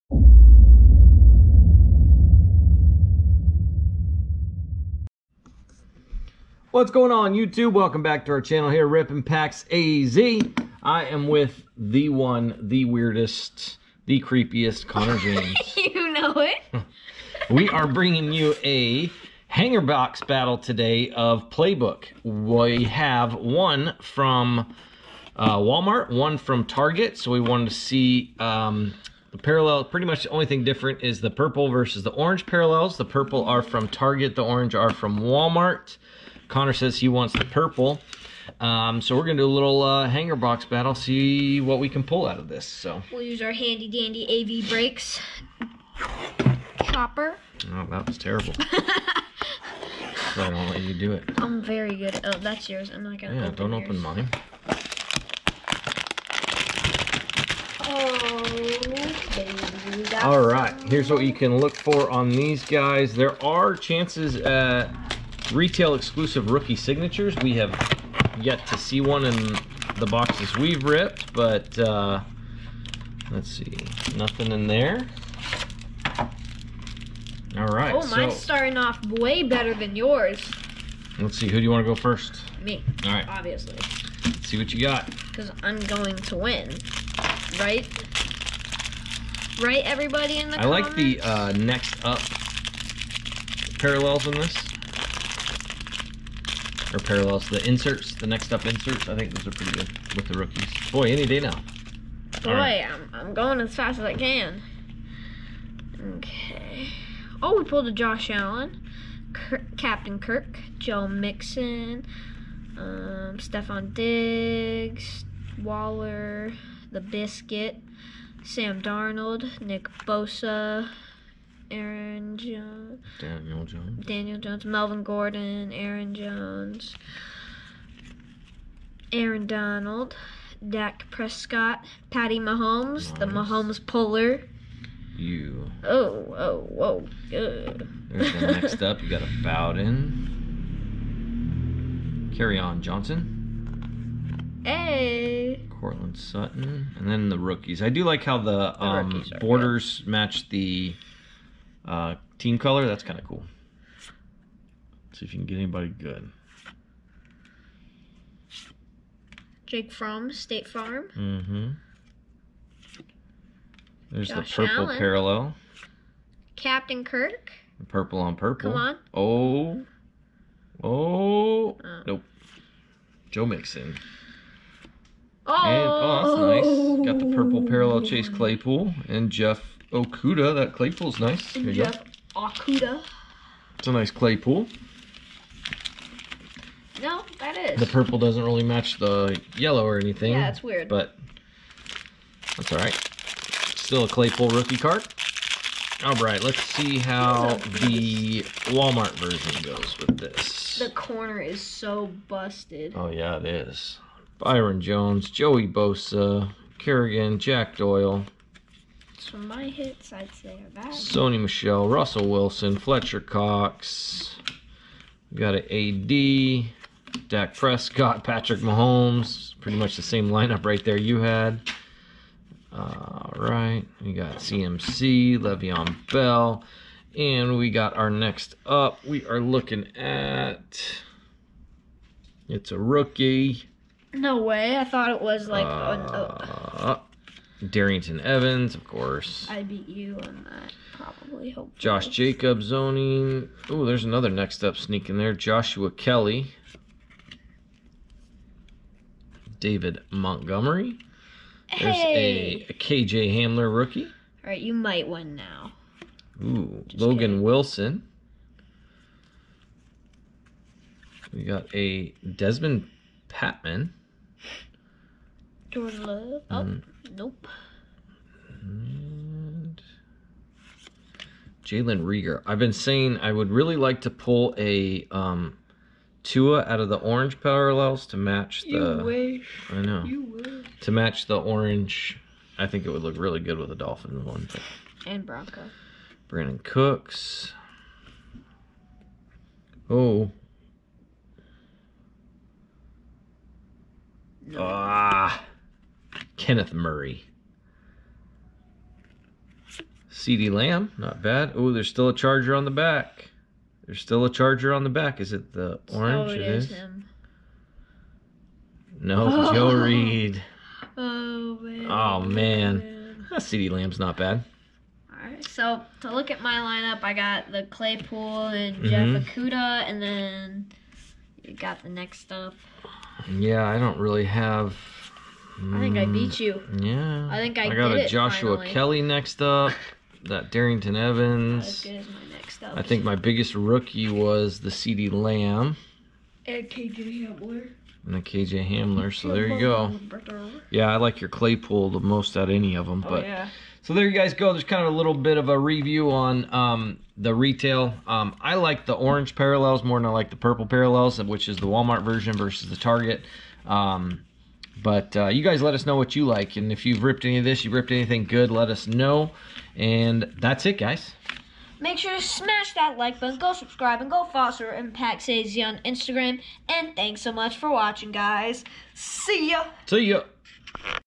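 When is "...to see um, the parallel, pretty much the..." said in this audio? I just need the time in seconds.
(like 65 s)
27 s.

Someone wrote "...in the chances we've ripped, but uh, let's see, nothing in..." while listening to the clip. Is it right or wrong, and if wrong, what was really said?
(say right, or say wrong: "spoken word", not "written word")
wrong: "boxes", not "chances".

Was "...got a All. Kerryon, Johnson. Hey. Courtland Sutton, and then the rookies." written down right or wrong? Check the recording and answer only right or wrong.
wrong.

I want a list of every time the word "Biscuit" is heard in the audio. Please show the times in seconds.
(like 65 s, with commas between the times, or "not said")
117 s.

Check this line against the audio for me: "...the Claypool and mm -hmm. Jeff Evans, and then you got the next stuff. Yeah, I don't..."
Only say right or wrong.
wrong.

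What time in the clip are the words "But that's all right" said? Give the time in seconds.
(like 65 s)
190 s.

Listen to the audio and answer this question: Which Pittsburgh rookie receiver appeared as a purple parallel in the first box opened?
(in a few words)
Chase Claypool.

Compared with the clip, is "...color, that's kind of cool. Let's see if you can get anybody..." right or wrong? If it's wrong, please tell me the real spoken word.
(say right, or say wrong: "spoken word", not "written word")
right.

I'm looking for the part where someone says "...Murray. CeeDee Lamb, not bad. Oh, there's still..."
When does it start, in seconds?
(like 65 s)
296 s.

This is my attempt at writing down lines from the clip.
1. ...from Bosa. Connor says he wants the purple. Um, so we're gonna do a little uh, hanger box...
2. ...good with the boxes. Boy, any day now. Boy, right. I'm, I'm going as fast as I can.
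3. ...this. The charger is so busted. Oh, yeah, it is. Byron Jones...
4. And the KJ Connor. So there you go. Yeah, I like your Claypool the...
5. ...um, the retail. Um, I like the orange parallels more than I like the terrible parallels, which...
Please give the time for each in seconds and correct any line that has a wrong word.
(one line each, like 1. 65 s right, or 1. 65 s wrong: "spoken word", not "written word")
1. 34 s wrong: "Walmart", not "Bosa"
2. 99 s wrong: "rookies", not "boxes"
3. 200 s wrong: "corner", not "charger"
4. 338 s wrong: "Hamler", not "Connor"
5. 346 s wrong: "purple", not "terrible".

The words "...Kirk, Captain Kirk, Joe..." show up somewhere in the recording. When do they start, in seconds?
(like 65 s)
109 s.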